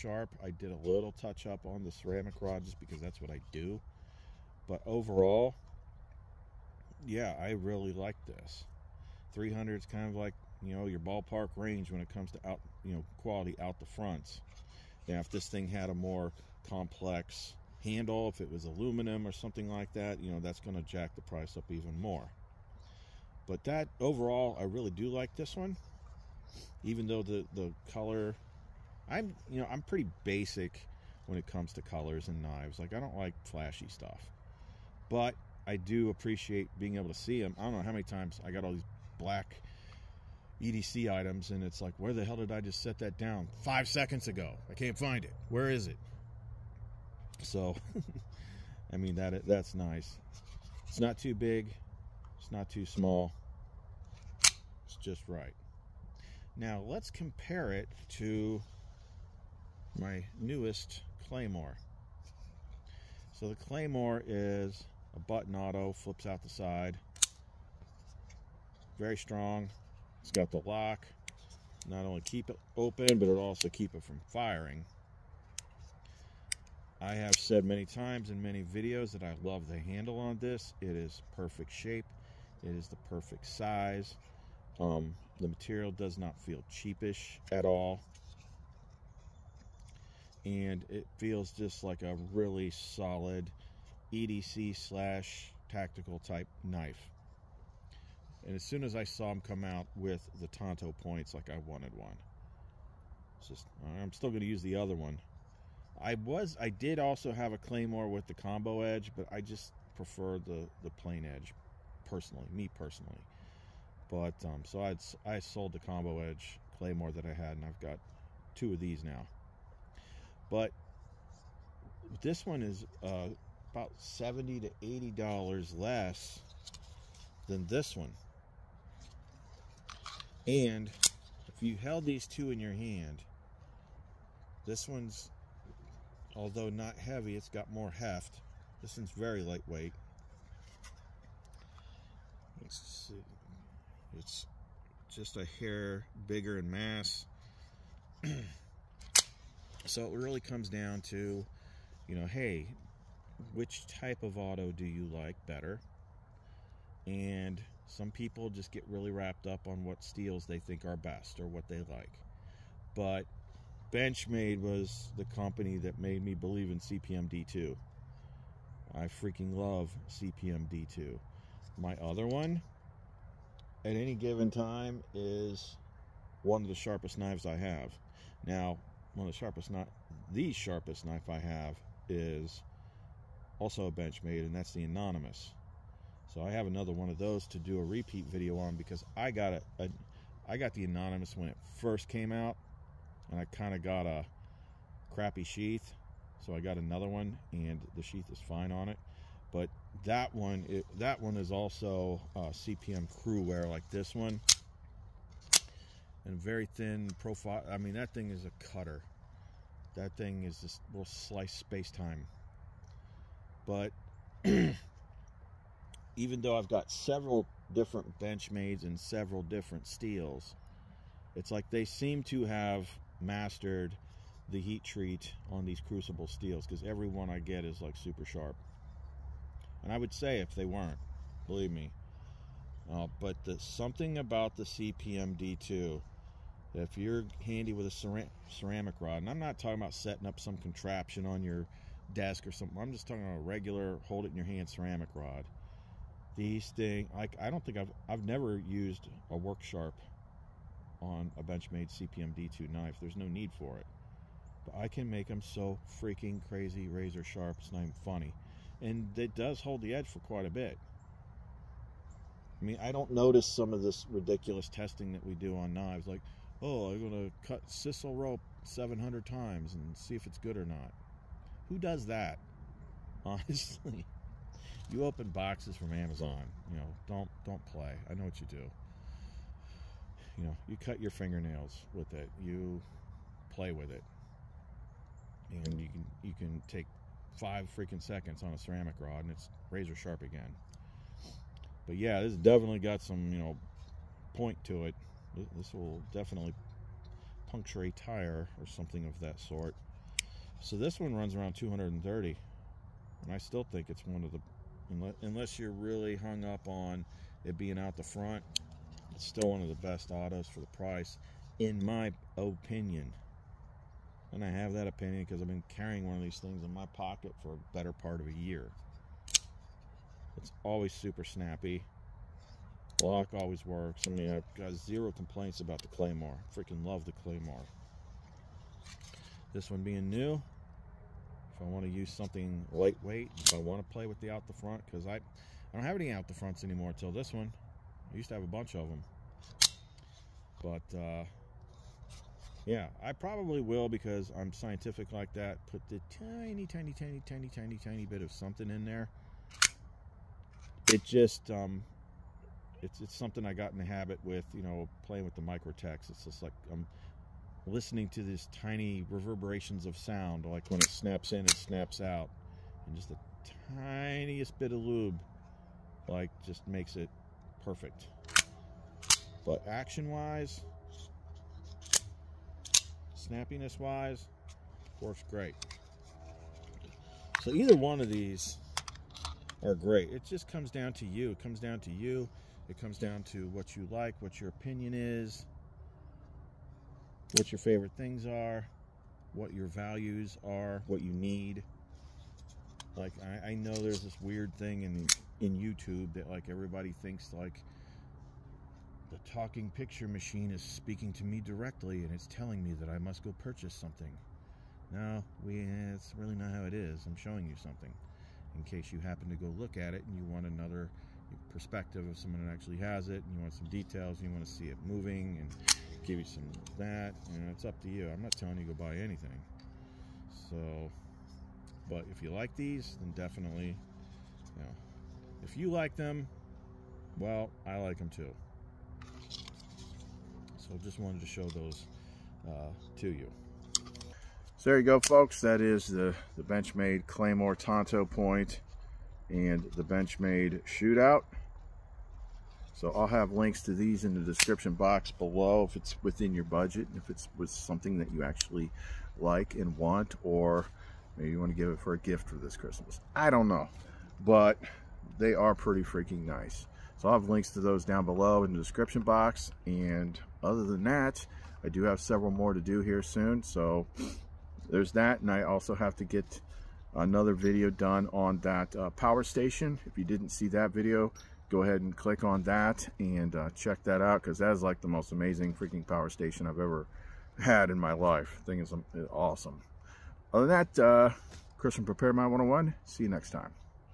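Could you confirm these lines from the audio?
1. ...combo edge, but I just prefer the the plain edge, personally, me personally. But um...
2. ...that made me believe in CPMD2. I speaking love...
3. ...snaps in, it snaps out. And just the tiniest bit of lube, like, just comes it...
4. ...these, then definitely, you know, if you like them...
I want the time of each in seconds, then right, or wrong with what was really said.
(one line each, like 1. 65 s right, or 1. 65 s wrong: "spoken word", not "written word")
1. 108 s right
2. 165 s wrong: "freaking", not "speaking"
3. 360 s wrong: "makes", not "comes"
4. 422 s right.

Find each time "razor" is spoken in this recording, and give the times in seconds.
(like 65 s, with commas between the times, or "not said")
256 s, 289 s.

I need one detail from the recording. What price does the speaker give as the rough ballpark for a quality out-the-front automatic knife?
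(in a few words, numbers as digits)
300.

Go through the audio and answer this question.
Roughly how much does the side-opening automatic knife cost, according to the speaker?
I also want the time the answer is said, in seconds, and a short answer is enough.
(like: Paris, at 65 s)
230, at 301 s.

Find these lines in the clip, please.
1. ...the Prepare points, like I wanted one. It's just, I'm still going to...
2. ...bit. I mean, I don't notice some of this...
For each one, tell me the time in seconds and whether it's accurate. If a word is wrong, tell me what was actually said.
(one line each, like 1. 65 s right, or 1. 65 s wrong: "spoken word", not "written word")
1. 100 s wrong: "Tanto", not "Prepare"
2. 260 s right.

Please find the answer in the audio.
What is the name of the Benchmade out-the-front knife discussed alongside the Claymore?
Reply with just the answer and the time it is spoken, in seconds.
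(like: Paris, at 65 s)
Shootout, at 440 s.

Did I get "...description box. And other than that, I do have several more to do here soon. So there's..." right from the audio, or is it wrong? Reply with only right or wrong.
right.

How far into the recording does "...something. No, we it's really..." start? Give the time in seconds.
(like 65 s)
403 s.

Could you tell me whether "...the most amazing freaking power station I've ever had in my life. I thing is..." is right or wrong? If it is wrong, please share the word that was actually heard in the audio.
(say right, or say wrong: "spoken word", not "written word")
right.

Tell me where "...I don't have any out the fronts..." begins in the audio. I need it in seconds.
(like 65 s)
335 s.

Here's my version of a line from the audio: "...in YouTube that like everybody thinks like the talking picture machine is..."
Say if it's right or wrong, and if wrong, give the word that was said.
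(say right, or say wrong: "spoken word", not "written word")
right.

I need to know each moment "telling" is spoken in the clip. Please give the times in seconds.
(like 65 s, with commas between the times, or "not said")
402 s, 418 s.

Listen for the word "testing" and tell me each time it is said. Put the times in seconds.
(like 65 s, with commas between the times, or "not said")
264 s.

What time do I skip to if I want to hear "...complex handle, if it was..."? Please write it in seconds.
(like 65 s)
16 s.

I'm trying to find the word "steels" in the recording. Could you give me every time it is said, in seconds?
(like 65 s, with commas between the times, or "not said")
160 s, 219 s, 226 s.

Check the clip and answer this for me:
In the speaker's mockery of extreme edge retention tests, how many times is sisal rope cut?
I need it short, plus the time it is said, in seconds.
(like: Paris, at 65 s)
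700, at 268 s.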